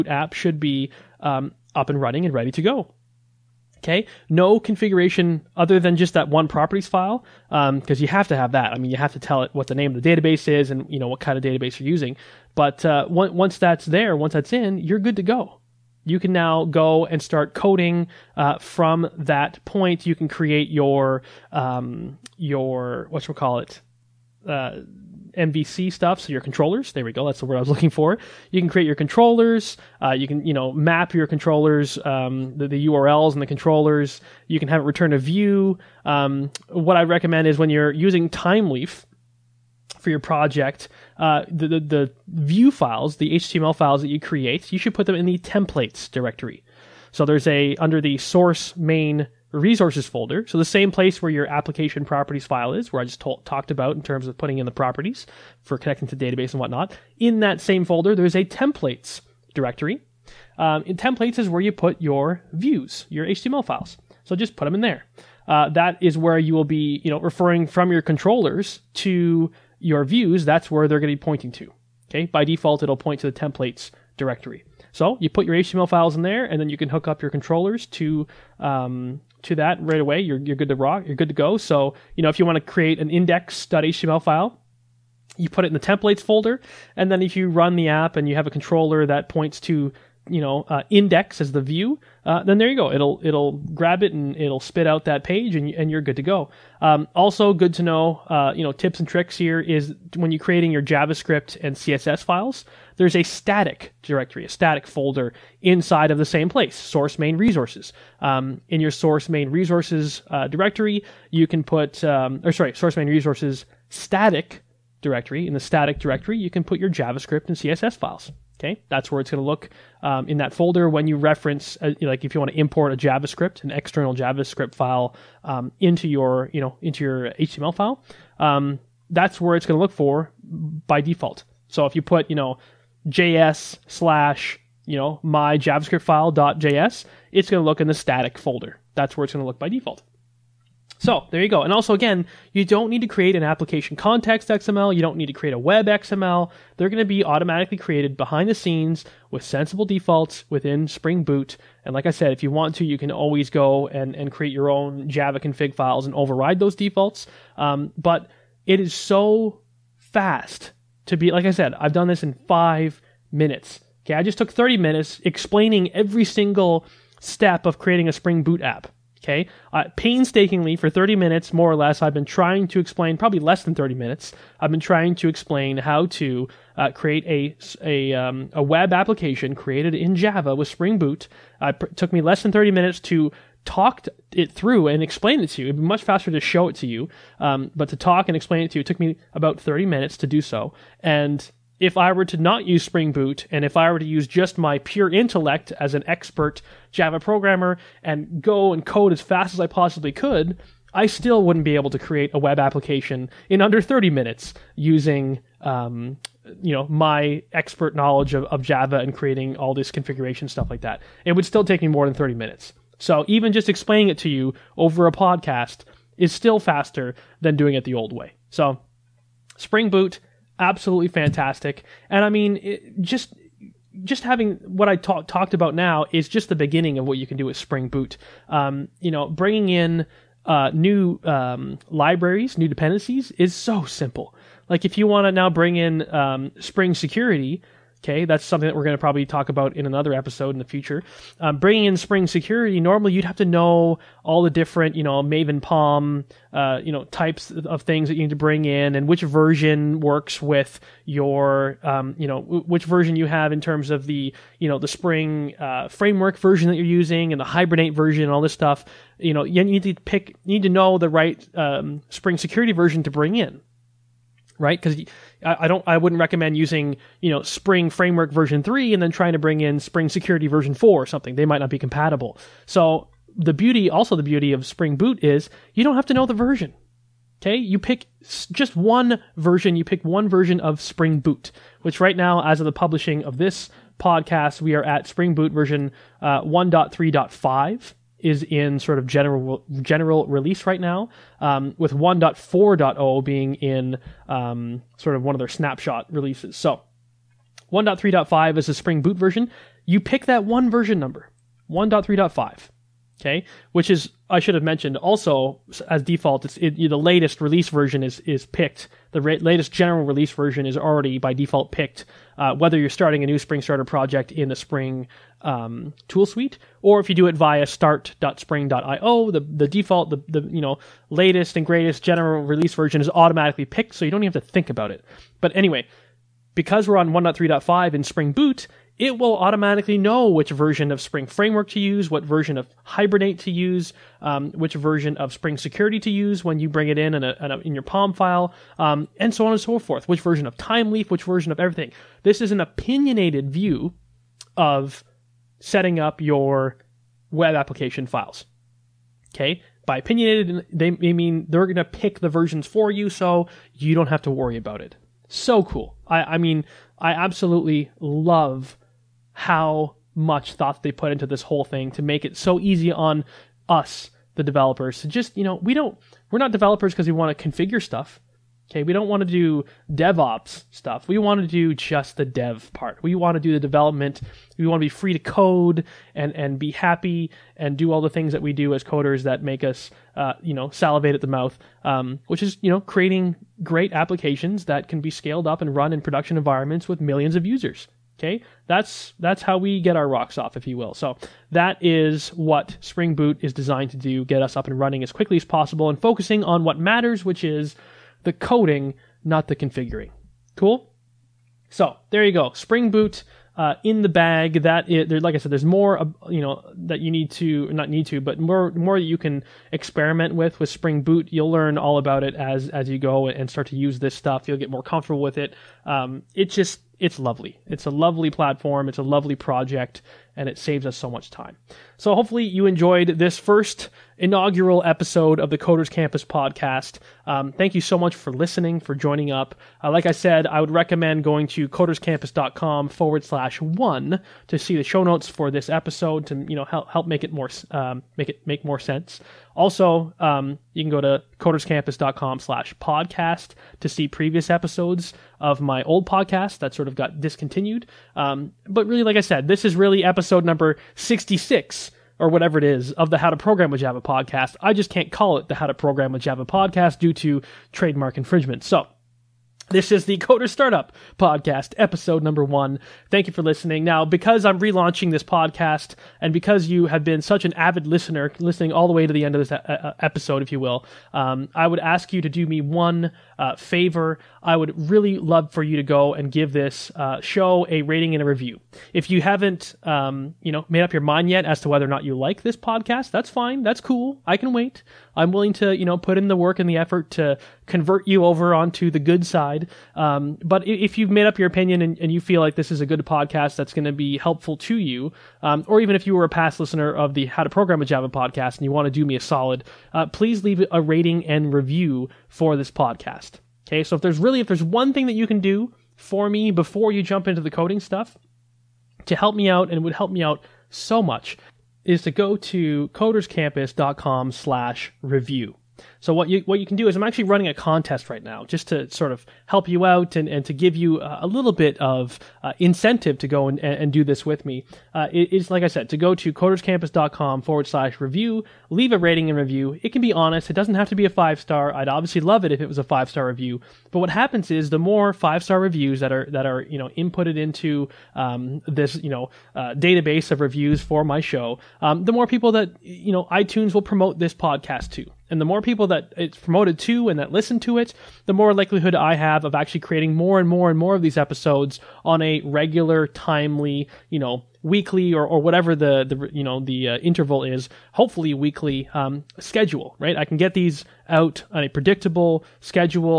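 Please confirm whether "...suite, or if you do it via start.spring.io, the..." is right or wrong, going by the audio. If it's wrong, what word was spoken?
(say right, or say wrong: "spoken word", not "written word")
right.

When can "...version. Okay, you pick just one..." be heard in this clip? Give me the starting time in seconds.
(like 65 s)
276 s.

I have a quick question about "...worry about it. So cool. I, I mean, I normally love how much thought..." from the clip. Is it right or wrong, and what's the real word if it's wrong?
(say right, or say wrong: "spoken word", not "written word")
wrong: "absolutely", not "normally".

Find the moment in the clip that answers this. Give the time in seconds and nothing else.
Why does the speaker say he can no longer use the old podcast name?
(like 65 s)
457 s.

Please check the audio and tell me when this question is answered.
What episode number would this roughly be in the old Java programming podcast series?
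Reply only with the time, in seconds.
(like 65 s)
450 s.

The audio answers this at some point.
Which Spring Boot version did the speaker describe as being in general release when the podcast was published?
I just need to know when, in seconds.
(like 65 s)
286 s.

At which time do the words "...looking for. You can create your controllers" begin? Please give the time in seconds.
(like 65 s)
27 s.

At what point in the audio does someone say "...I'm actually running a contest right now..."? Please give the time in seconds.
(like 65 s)
516 s.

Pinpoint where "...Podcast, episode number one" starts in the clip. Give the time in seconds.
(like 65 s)
461 s.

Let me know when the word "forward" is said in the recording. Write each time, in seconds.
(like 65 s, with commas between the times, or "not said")
432 s, 527 s.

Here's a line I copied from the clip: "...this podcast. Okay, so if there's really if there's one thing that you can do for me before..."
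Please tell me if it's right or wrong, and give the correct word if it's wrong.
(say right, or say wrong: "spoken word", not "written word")
right.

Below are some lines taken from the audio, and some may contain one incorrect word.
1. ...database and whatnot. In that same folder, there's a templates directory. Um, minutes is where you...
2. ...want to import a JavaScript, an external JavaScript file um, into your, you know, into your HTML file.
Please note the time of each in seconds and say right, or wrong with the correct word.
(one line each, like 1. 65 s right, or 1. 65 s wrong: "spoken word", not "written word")
1. 56 s wrong: "templates", not "minutes"
2. 122 s right.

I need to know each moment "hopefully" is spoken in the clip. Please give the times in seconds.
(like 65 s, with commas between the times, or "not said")
422 s, 557 s.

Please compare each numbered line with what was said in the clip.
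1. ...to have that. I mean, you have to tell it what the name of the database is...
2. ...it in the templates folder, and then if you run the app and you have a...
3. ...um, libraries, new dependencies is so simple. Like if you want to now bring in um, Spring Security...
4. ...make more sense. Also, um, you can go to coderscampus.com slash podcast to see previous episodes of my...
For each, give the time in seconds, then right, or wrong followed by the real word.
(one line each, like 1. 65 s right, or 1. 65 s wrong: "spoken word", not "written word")
1. 8 s right
2. 85 s right
3. 231 s right
4. 438 s right.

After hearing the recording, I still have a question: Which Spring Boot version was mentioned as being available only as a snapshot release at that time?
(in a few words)
1.4.0.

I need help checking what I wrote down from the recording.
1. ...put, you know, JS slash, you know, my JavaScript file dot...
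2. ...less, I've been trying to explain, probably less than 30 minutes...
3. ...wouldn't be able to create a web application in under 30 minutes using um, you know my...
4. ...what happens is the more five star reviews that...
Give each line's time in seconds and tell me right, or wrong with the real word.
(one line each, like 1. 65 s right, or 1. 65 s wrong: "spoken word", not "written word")
1. 132 s right
2. 171 s right
3. 201 s right
4. 534 s right.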